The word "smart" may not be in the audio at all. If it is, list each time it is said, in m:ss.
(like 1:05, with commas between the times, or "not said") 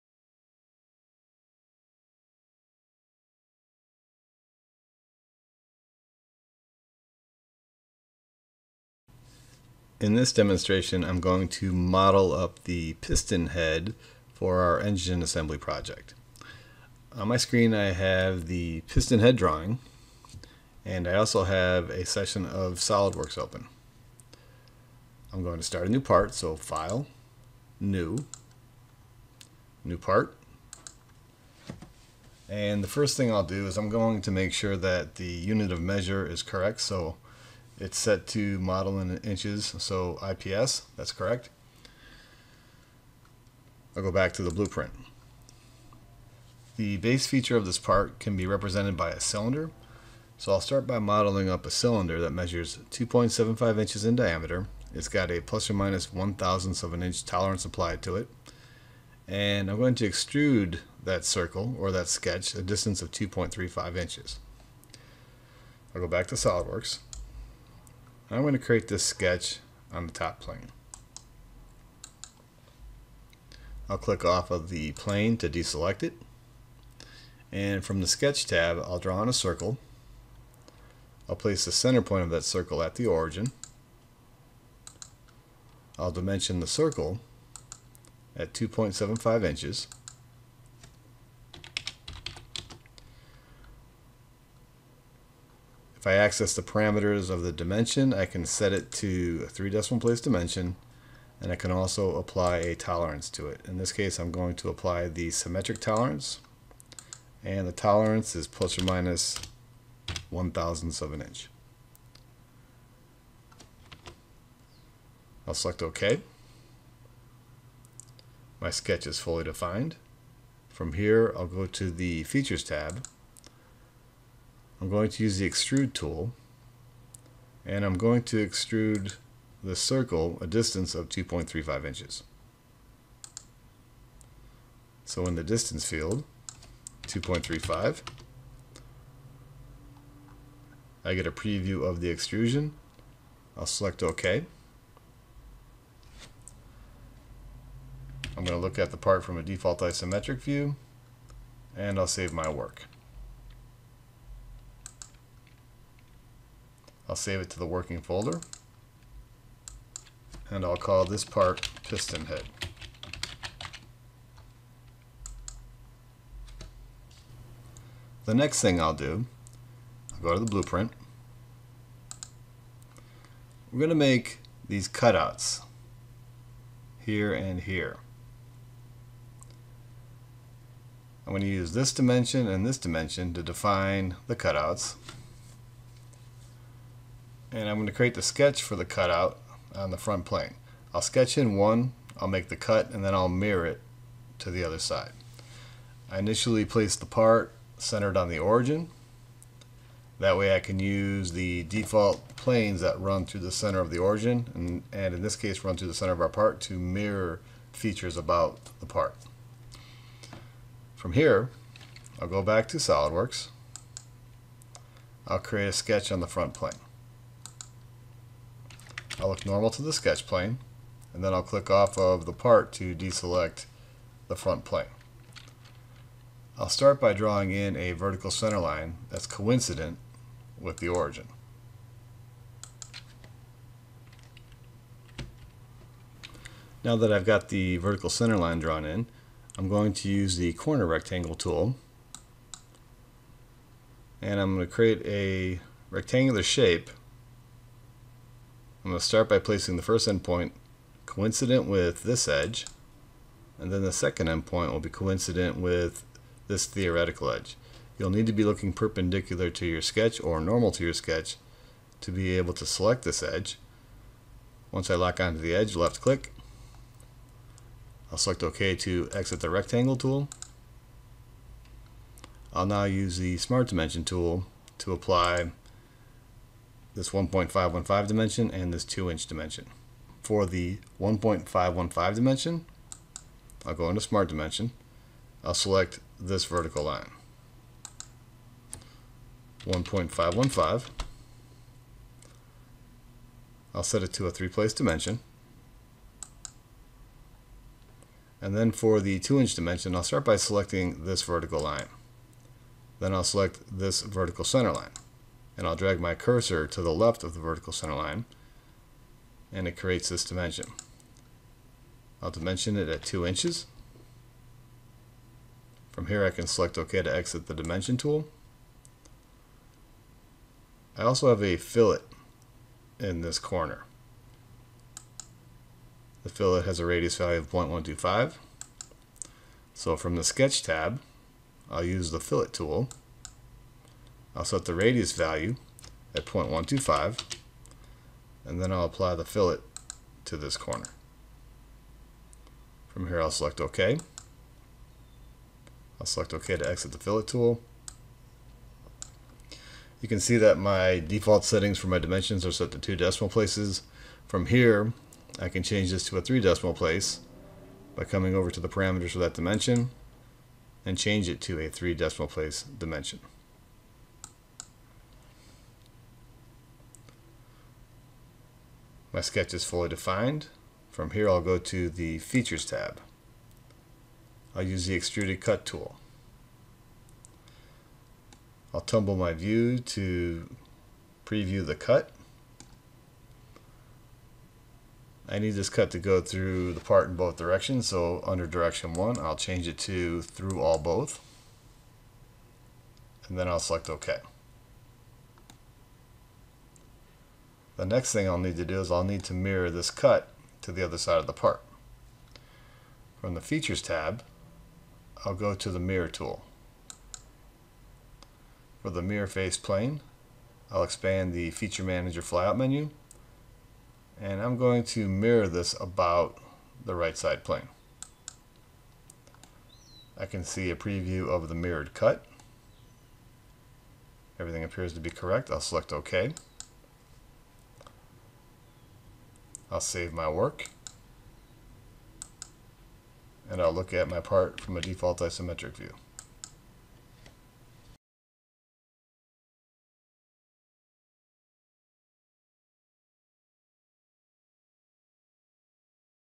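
4:33, 4:44.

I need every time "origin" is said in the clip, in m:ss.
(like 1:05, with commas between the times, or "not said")
1:23, 3:18, 3:23, 3:50.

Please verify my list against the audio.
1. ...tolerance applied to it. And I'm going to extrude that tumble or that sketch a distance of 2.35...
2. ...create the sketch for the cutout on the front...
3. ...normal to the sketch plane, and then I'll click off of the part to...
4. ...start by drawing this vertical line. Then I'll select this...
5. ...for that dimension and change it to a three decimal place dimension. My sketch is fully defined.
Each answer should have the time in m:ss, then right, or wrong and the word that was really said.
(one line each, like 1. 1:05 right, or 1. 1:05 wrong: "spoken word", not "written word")
1. 0:57 wrong: "circle", not "tumble"
2. 3:07 right
3. 3:39 right
4. 5:00 wrong: "selecting", not "drawing"
5. 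5:59 right.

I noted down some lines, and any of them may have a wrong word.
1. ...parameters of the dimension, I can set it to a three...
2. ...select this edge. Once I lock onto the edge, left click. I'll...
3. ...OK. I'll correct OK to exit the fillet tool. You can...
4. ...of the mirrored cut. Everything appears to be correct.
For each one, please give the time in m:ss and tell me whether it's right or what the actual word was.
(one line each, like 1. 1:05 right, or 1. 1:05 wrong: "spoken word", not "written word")
1. 1:36 right
2. 4:22 right
3. 5:43 wrong: "select", not "correct"
4. 7:01 right.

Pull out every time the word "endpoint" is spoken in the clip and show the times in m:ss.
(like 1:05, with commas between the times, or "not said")
4:10, 4:14.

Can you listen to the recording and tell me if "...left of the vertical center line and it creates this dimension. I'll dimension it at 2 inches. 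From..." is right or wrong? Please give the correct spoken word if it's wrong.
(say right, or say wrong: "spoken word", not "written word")
right.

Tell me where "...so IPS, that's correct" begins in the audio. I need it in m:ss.
0:39.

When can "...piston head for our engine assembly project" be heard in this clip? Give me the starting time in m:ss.
0:13.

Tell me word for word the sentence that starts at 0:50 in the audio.
So I'll start by modeling up a cylinder that measures 2.75 inches in diameter.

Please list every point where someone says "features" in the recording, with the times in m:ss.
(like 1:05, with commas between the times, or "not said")
0:47, 2:02, 3:27, 6:12, 6:43, 6:51.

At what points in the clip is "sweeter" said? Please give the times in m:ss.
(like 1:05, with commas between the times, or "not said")
not said.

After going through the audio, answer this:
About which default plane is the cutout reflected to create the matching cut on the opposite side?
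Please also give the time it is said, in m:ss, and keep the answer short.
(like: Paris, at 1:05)
right side plane, at 6:56.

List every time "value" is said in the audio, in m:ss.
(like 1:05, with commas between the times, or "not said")
5:27, 5:35.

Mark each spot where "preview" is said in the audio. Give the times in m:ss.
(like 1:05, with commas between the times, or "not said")
2:21, 6:21, 7:00.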